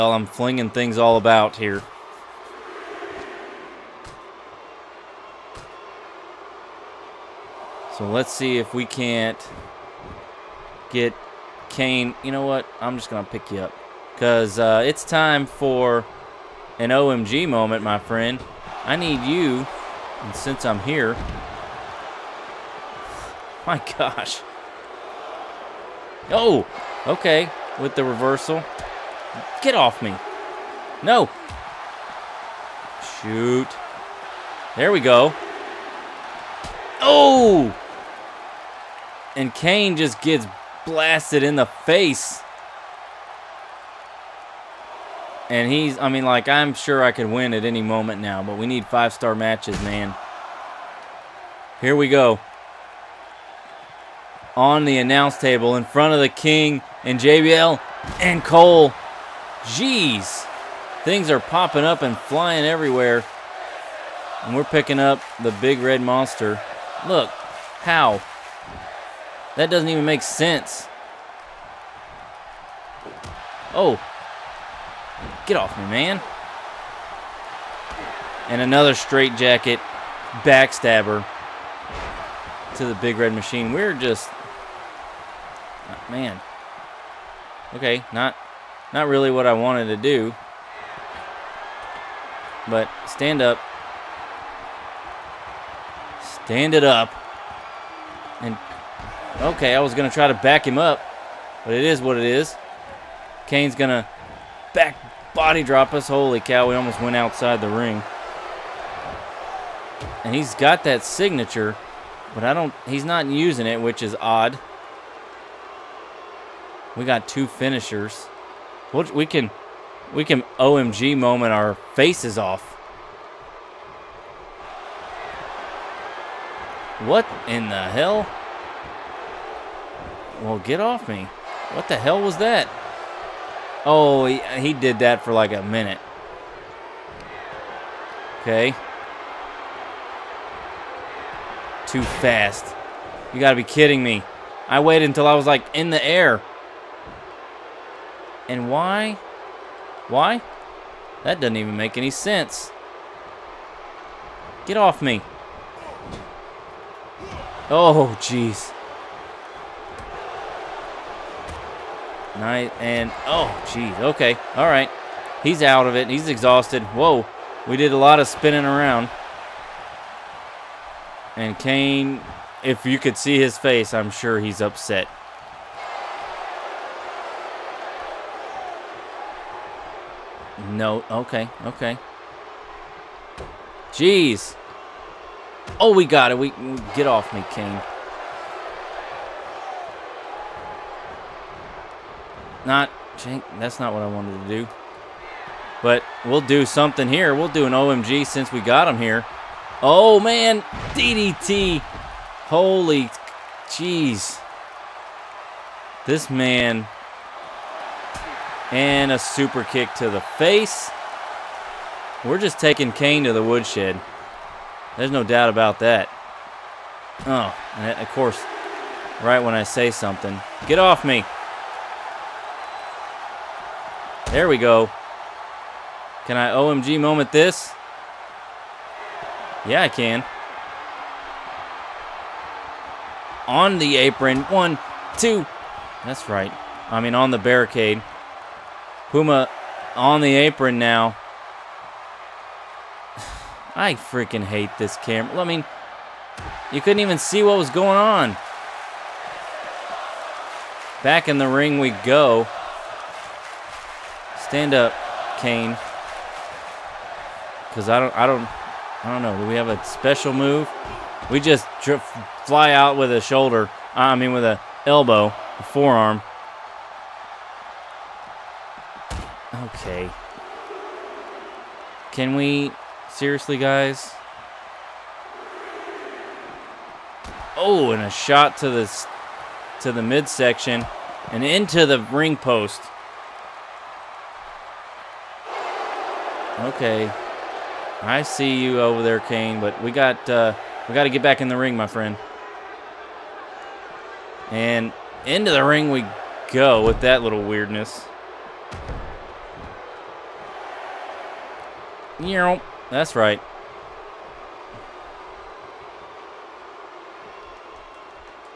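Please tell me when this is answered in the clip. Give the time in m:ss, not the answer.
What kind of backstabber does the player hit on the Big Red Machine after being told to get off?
1:18.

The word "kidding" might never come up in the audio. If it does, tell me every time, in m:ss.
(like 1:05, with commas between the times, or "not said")
2:23.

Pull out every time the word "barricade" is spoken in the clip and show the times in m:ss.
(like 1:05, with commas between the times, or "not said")
3:57.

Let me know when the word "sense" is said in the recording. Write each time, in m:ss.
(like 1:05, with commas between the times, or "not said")
1:10, 2:32.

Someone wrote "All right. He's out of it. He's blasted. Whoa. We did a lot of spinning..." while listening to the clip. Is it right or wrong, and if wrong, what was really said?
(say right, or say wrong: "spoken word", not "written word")
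wrong: "exhausted", not "blasted".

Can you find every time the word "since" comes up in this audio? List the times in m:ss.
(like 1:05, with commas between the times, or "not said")
0:20, 3:18.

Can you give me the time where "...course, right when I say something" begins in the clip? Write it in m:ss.
3:38.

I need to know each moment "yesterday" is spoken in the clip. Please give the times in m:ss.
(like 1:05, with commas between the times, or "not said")
not said.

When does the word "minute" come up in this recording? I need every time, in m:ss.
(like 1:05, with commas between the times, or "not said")
2:15.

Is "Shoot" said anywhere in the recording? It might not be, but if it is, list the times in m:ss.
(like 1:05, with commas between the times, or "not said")
0:33.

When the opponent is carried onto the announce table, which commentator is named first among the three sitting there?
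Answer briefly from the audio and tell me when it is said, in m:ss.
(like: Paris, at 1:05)
The King, at 0:56.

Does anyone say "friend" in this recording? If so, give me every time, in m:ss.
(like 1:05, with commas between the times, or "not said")
0:17, 4:51.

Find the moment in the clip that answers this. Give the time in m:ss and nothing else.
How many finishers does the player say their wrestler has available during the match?
1:57.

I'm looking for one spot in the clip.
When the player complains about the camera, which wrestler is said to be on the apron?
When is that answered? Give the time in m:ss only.
3:59.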